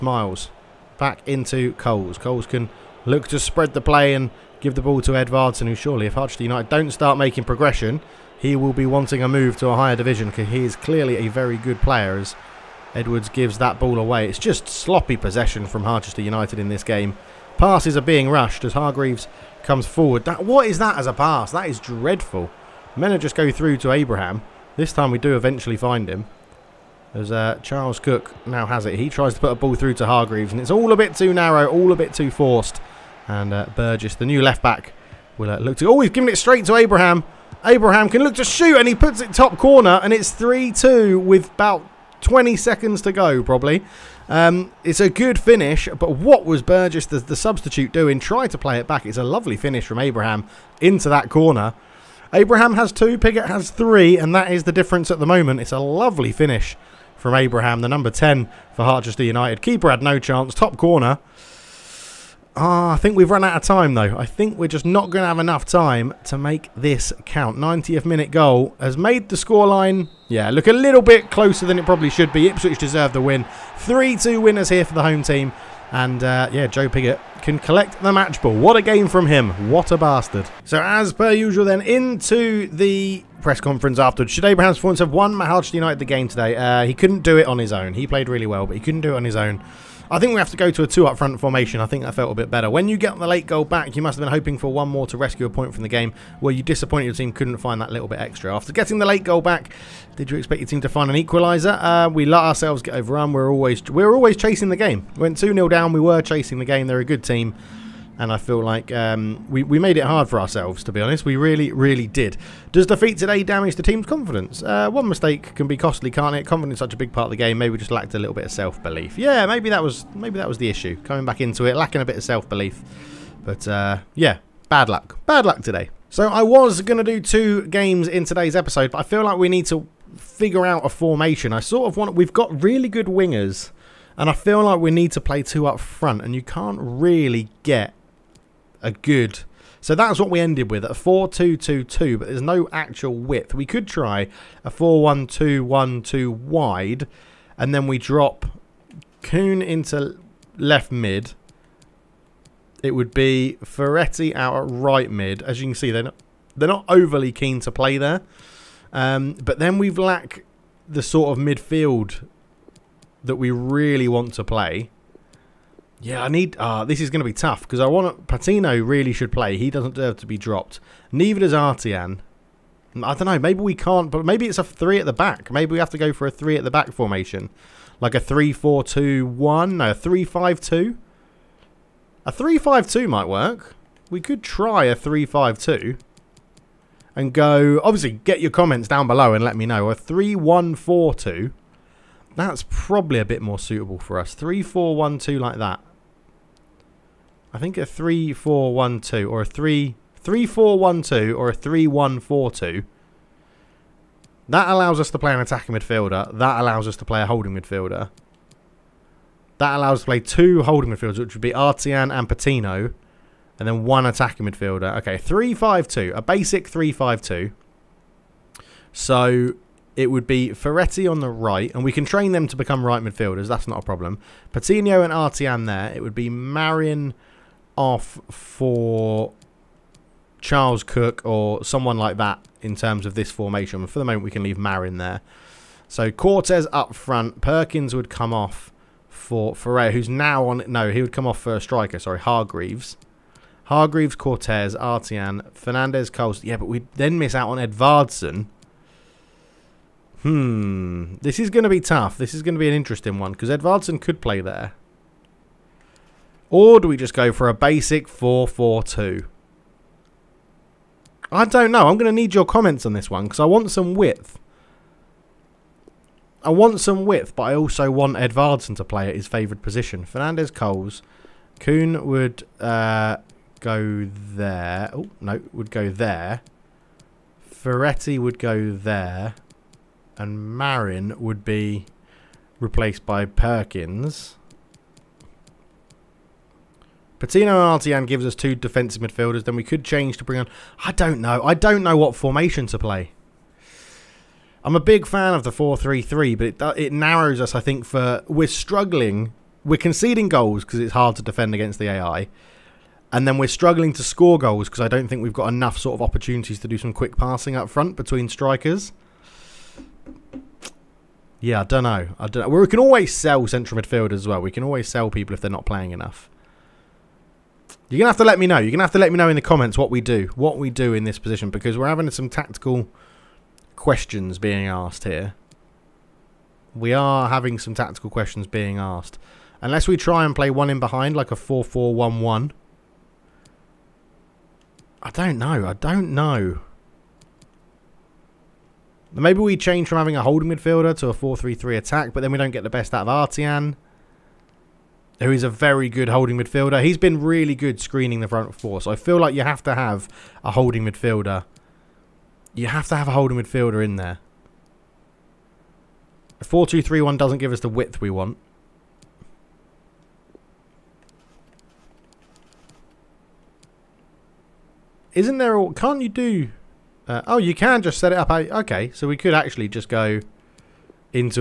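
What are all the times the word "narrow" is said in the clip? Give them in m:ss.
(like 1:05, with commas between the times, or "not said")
0:31, 4:56.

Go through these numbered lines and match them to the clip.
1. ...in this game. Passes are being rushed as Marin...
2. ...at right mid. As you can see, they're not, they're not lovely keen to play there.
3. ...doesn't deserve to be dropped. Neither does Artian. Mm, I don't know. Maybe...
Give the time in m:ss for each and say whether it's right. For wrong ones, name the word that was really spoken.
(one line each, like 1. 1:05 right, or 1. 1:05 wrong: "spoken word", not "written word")
1. 0:16 wrong: "Hargreaves", not "Marin"
2. 2:34 wrong: "overly", not "lovely"
3. 2:49 right.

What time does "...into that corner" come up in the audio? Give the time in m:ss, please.
0:50.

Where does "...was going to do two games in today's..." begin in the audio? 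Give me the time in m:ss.
2:06.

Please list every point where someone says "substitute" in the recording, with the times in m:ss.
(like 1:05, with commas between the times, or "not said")
0:47.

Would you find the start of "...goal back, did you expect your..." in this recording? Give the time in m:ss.
1:39.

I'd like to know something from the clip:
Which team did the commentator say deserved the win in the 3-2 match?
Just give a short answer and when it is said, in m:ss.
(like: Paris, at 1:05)
Ipswich, at 1:12.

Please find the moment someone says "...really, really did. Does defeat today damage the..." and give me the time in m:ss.
1:51.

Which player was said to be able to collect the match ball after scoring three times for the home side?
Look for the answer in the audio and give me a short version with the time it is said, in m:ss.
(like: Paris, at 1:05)
Joe Piggott, at 1:16.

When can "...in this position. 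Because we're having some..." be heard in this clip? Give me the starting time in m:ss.
5:20.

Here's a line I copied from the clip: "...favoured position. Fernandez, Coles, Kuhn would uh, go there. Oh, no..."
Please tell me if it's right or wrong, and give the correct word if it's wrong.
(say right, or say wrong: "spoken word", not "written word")
right.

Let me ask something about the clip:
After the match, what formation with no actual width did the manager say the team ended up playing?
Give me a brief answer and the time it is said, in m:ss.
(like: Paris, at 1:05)
4-2-2-2, at 2:20.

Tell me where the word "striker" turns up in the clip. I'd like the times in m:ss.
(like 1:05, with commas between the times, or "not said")
4:01, 5:08.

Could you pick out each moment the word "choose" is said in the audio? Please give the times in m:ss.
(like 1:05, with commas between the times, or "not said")
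not said.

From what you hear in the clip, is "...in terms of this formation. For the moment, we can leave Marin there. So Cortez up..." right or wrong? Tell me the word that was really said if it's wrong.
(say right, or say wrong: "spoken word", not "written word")
right.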